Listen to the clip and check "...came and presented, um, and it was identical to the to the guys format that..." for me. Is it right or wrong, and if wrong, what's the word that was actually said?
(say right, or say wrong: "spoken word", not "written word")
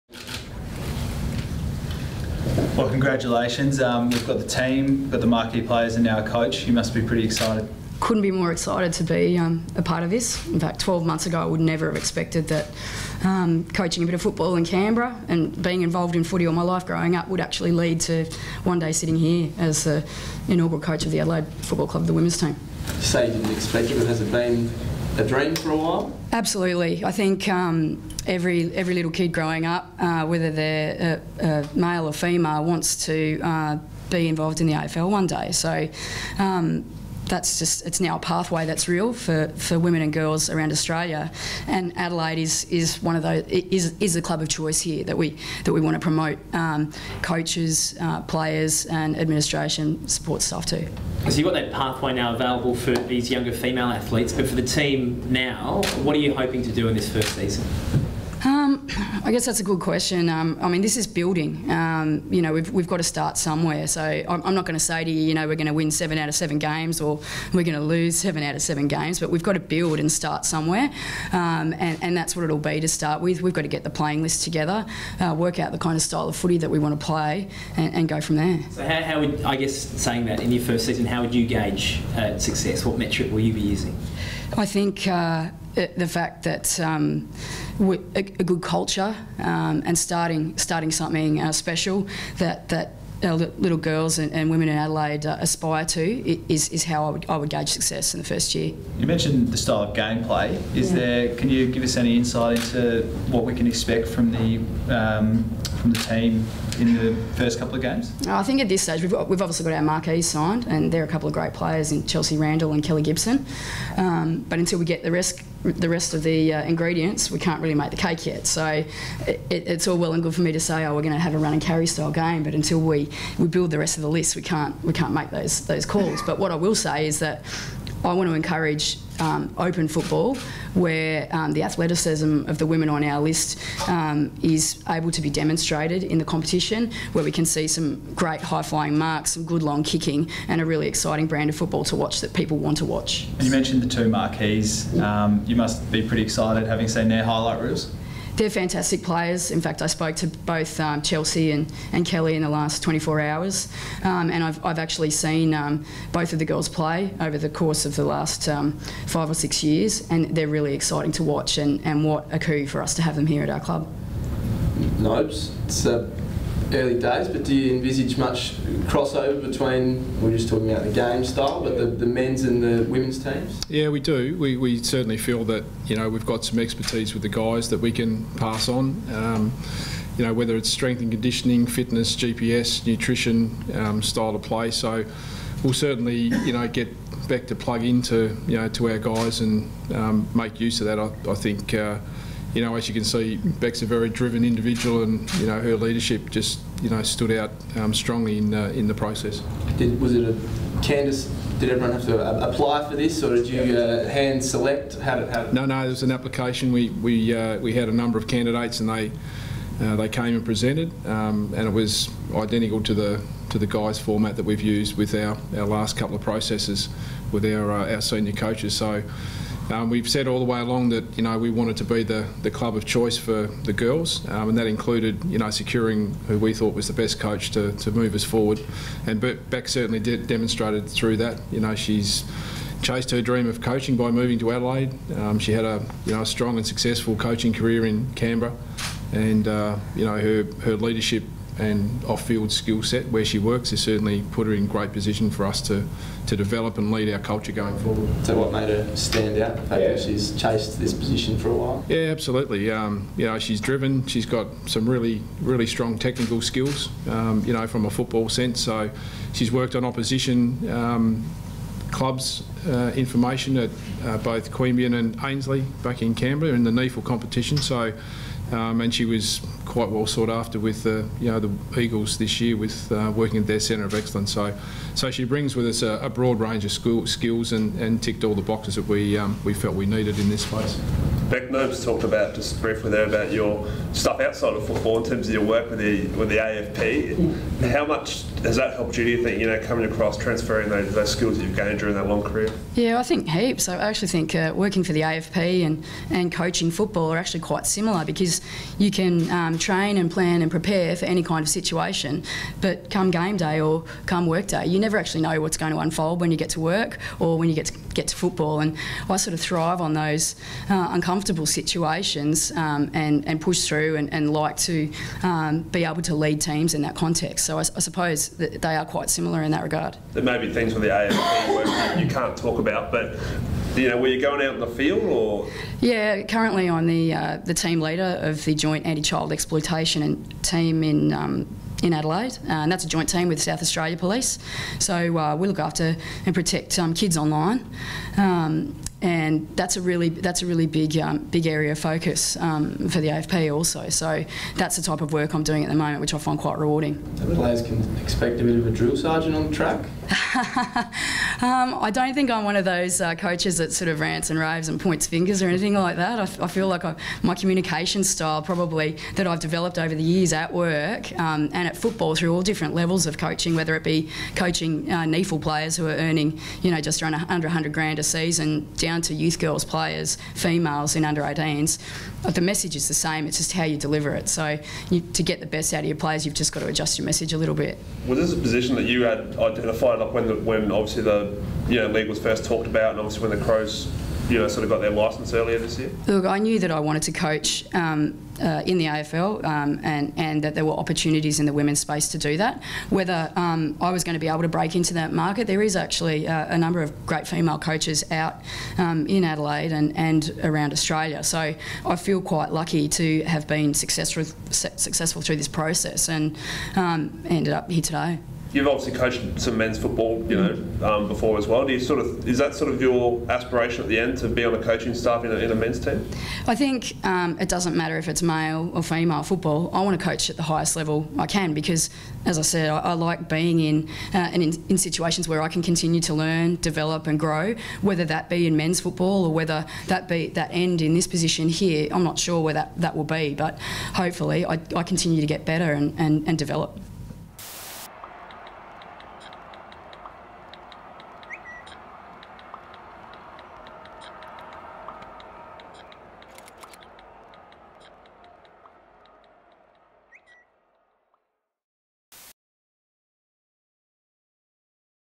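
right.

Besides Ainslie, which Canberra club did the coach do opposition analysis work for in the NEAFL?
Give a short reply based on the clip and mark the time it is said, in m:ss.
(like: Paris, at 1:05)
Queanbeyan, at 4:24.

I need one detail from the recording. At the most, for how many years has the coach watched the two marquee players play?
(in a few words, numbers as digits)
6.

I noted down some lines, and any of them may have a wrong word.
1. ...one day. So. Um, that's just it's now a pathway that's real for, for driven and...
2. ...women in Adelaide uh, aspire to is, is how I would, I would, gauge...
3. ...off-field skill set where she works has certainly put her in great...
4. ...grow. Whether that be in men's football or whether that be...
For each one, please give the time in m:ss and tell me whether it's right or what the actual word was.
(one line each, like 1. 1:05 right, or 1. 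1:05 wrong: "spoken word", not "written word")
1. 0:35 wrong: "women", not "driven"
2. 1:34 right
3. 4:02 right
4. 7:07 right.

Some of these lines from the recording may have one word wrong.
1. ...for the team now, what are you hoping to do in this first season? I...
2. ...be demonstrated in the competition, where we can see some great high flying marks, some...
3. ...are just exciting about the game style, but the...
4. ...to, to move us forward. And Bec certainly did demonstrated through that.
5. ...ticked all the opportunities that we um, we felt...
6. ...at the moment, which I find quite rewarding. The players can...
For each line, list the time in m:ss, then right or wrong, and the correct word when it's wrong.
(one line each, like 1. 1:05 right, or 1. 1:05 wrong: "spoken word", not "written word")
1. 0:54 right
2. 2:15 right
3. 2:50 wrong: "talking", not "exciting"
4. 3:47 right
5. 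4:38 wrong: "boxes", not "opportunities"
6. 5:45 right.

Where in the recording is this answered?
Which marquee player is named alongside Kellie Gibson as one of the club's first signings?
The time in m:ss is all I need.
1:52.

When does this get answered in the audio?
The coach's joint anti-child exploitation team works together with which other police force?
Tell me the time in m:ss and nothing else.
5:33.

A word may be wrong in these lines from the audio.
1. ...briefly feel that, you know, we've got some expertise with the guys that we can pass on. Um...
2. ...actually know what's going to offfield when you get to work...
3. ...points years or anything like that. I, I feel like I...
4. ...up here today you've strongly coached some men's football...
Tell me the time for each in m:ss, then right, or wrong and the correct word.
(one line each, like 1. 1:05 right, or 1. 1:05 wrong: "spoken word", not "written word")
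1. 2:54 wrong: "certainly", not "briefly"
2. 5:04 wrong: "unfold", not "offfield"
3. 5:54 wrong: "fingers", not "years"
4. 6:47 wrong: "obviously", not "strongly".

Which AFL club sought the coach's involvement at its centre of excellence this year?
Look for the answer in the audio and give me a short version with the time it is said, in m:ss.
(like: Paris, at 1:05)
the Eagles, at 4:31.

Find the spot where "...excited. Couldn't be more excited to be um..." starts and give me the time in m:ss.
0:07.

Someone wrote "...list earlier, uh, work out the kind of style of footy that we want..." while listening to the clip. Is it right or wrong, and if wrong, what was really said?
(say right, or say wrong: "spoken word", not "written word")
wrong: "together", not "earlier".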